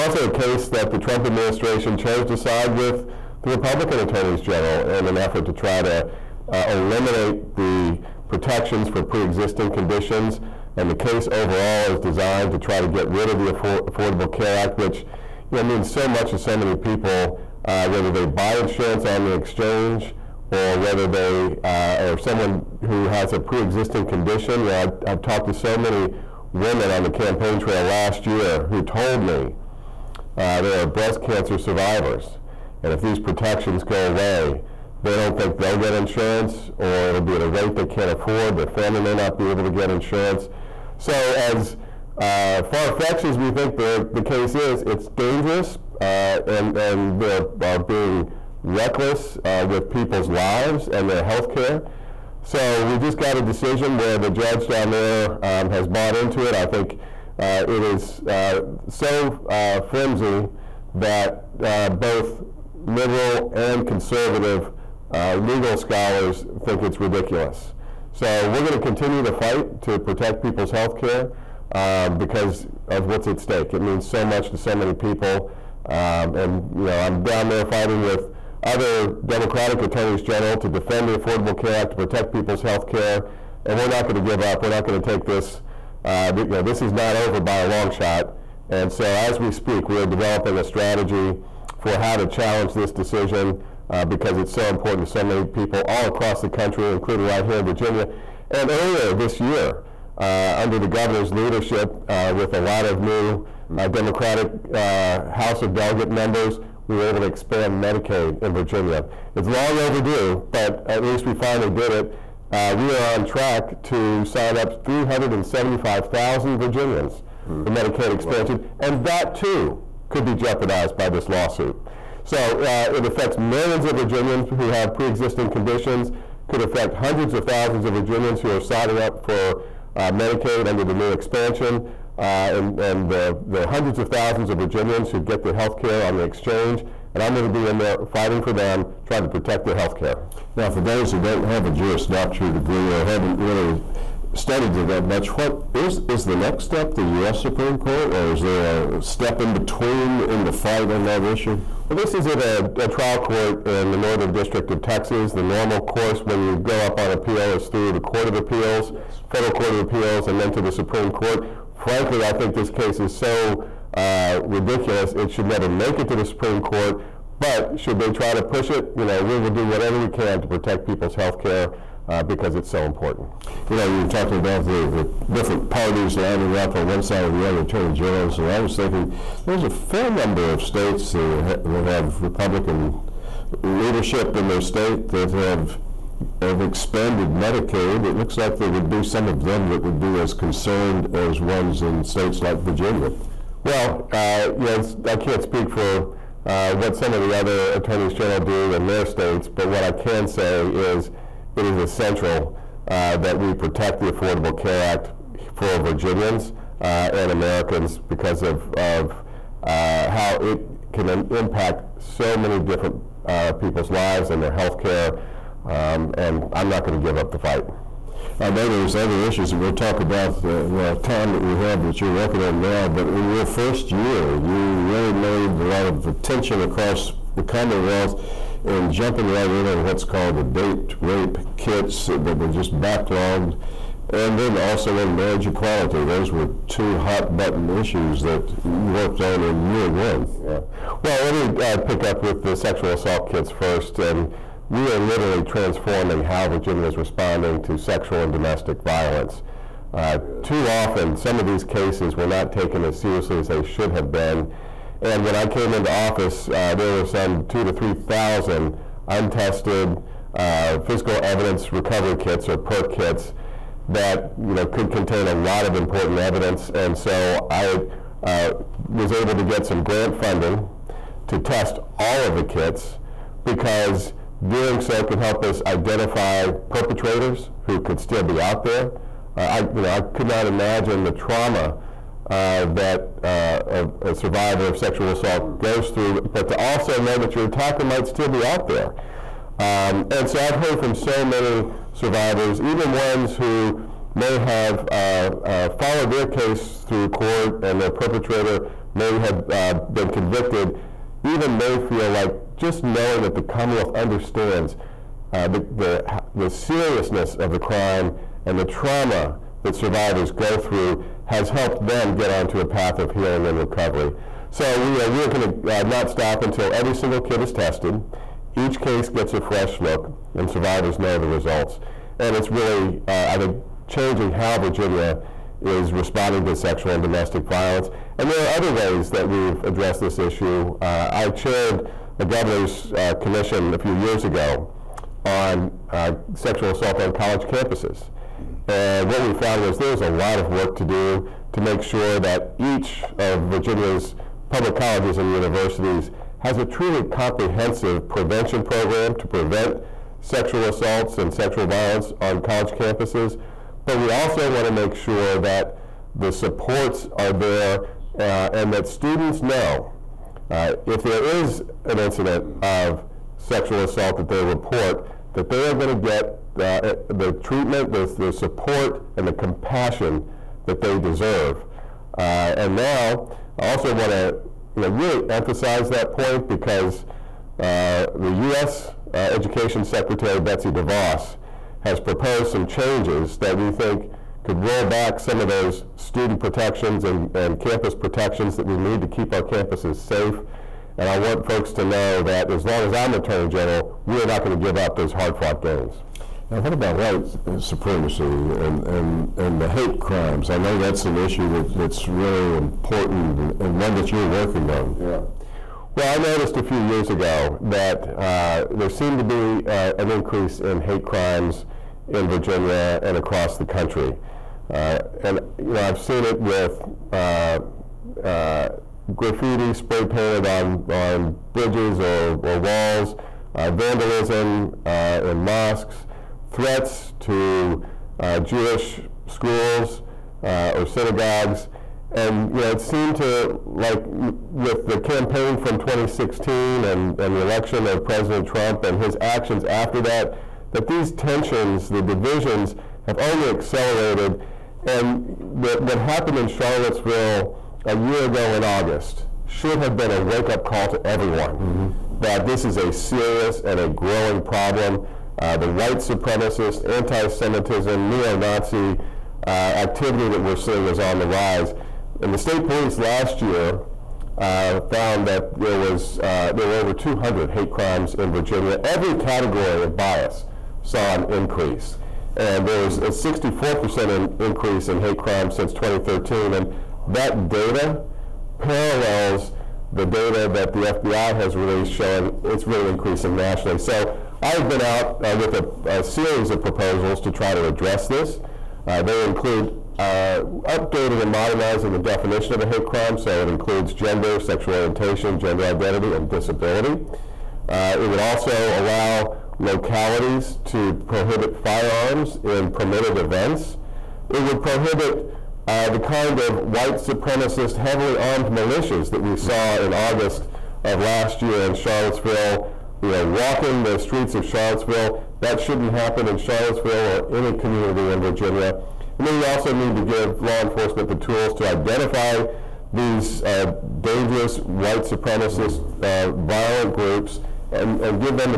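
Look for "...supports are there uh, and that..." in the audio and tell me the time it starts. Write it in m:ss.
5:56.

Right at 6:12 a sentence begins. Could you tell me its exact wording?
Uh, and now, I also want to you know, really emphasize that point because uh, the U.S.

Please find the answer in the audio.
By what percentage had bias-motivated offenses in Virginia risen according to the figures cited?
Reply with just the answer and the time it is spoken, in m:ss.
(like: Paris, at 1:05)
64%, at 7:53.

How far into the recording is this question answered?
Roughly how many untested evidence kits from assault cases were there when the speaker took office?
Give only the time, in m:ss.
4:17.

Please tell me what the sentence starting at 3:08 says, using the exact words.
It looks like there would be some of them that would be as concerned as ones in states like Virginia.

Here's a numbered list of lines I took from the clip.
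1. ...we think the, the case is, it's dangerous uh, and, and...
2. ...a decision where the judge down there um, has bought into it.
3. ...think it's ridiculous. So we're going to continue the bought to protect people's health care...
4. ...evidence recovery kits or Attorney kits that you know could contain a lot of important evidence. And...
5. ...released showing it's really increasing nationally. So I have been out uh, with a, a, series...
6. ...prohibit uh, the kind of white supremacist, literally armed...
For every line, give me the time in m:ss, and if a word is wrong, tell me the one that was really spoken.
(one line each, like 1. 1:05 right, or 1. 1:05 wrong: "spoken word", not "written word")
1. 0:43 right
2. 0:53 right
3. 1:06 wrong: "fight", not "bought"
4. 4:21 wrong: "PERK", not "Attorney"
5. 8:01 right
6. 8:24 wrong: "heavily", not "literally".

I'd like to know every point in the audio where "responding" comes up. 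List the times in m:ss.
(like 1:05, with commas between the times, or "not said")
4:06, 5:25.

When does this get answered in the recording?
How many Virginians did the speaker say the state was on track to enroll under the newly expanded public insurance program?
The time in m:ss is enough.
1:54.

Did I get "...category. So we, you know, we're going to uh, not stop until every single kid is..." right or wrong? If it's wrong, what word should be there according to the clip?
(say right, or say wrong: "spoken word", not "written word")
wrong: "recovery", not "category".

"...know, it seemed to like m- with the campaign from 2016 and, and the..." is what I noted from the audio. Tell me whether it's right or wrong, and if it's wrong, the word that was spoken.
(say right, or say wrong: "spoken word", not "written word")
right.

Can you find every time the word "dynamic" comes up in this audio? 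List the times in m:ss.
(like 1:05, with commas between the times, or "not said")
not said.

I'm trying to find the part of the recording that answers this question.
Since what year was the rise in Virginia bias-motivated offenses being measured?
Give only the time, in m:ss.
7:55.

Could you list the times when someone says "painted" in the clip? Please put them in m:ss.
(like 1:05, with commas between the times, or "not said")
7:00.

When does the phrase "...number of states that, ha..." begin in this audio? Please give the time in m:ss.
3:00.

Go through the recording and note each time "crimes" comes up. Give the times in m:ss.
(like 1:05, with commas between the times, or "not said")
5:07, 6:39, 6:51, 7:47, 7:55, 8:12.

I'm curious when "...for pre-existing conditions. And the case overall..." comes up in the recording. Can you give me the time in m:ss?
0:08.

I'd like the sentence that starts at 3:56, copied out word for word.
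Those were two hot button issues that you worked on in year one.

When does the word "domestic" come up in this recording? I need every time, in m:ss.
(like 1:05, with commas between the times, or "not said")
4:08, 5:27.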